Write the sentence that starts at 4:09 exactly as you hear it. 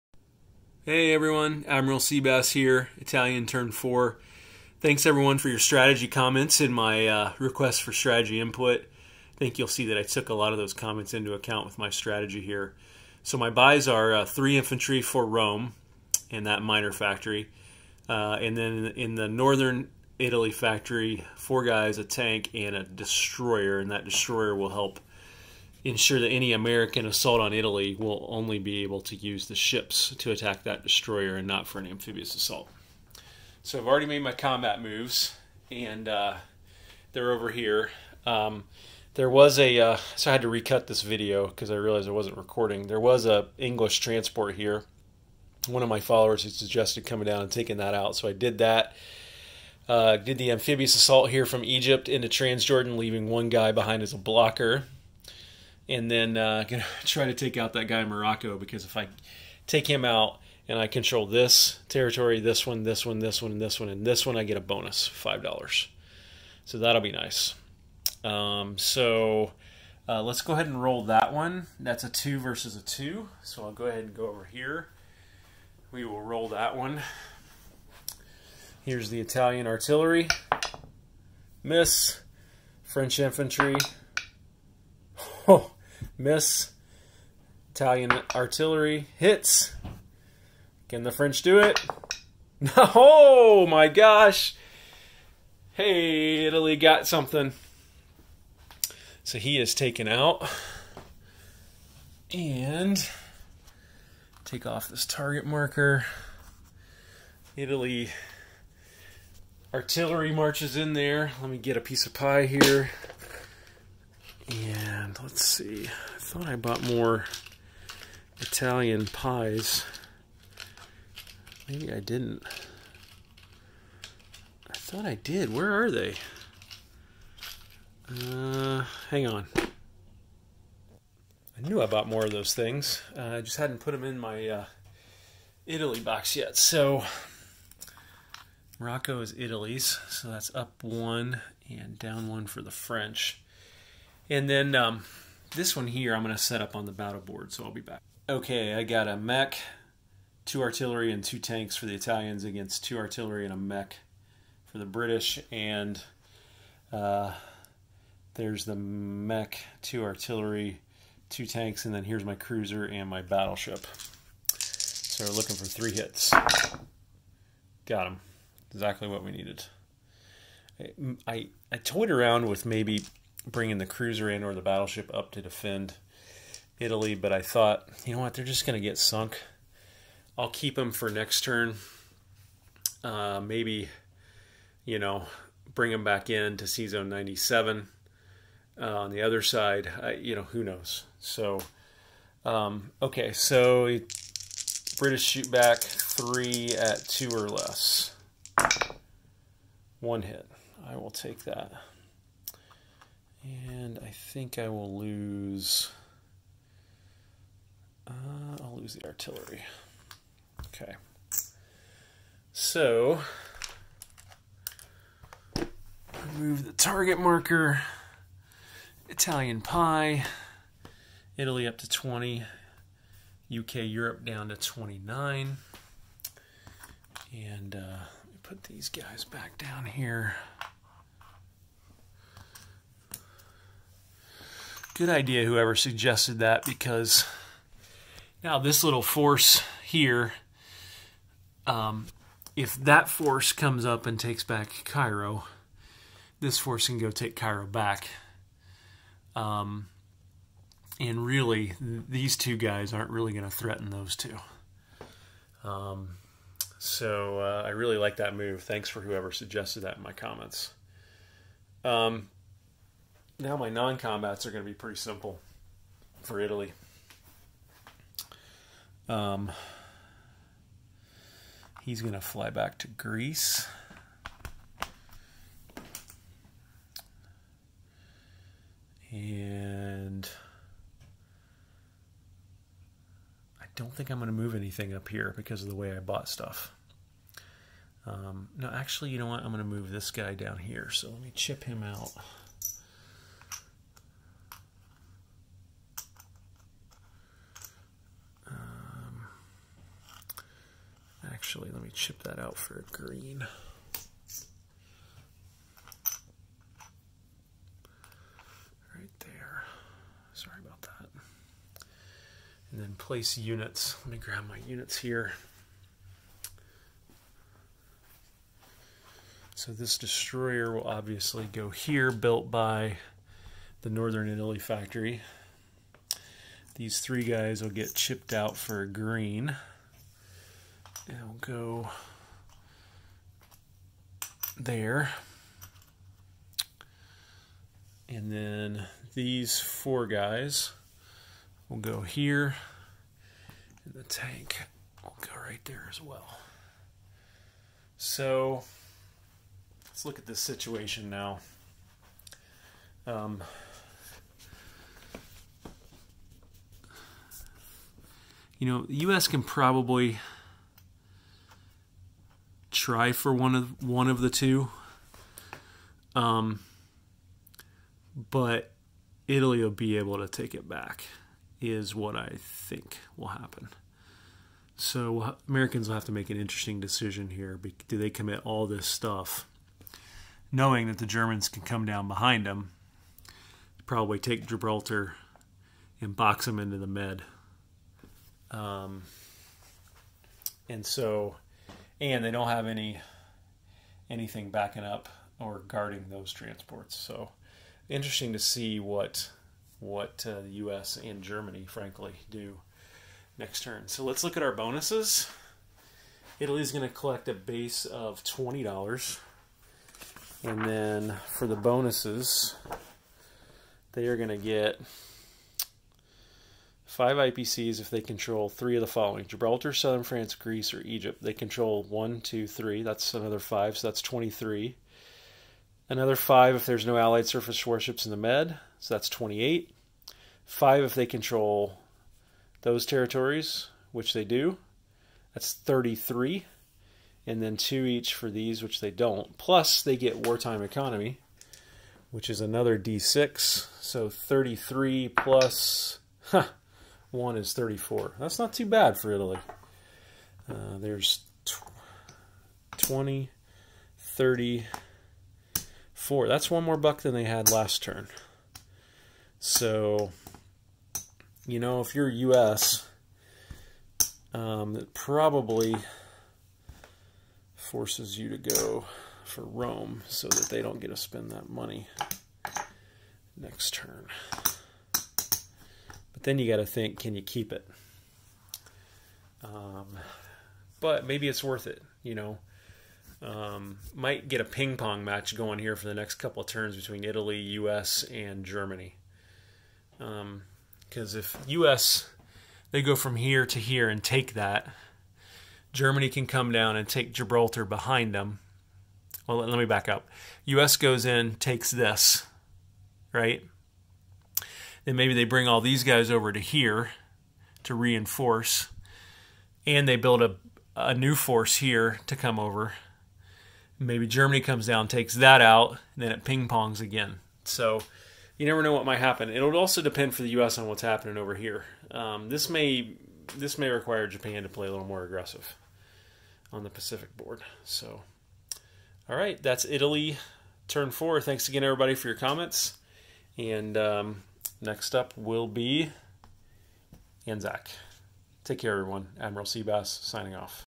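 Um, and really, these two guys aren't really going to threaten those two.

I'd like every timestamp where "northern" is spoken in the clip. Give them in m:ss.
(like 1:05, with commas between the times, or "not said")
0:19, 5:23.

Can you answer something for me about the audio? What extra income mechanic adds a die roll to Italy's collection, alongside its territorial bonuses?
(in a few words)
wartime economy.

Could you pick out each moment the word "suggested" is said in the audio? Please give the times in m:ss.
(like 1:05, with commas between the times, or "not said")
0:46, 3:55, 4:19.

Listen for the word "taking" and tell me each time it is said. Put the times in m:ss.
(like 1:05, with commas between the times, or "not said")
0:47.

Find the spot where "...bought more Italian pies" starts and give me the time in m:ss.
1:56.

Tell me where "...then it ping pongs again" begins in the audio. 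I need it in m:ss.
8:36.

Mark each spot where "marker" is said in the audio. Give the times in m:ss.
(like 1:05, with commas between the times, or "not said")
1:45, 3:37.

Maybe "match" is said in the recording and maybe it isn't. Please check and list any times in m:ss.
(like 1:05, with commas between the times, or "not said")
8:05.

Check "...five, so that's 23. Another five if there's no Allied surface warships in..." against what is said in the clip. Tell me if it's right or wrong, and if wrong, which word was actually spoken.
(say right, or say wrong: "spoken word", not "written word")
right.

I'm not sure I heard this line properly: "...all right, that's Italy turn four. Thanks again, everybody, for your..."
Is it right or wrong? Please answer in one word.
right.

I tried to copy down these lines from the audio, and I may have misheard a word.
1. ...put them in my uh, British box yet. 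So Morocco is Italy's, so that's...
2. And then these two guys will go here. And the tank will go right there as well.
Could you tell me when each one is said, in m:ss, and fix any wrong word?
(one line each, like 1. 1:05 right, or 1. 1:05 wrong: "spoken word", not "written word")
1. 2:13 wrong: "Italy", not "British"
2. 5:38 wrong: "four", not "two".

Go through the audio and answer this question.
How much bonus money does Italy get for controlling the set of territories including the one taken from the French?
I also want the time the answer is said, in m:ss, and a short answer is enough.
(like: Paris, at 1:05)
5 dollars, at 1:05.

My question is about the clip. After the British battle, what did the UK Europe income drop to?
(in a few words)
29.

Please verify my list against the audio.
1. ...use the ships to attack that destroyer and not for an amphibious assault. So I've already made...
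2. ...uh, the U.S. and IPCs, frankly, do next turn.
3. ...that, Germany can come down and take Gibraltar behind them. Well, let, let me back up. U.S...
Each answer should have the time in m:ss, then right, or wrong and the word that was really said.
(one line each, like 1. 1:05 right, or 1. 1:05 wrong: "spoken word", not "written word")
1. 0:29 right
2. 6:40 wrong: "Germany", not "IPCs"
3. 8:14 right.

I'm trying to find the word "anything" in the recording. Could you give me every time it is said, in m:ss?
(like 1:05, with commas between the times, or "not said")
4:44, 6:34.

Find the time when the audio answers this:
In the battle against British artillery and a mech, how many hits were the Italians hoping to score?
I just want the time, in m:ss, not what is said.
2:45.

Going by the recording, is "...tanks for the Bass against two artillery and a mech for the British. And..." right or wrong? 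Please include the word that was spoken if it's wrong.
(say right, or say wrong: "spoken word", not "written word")
wrong: "Italians", not "Bass".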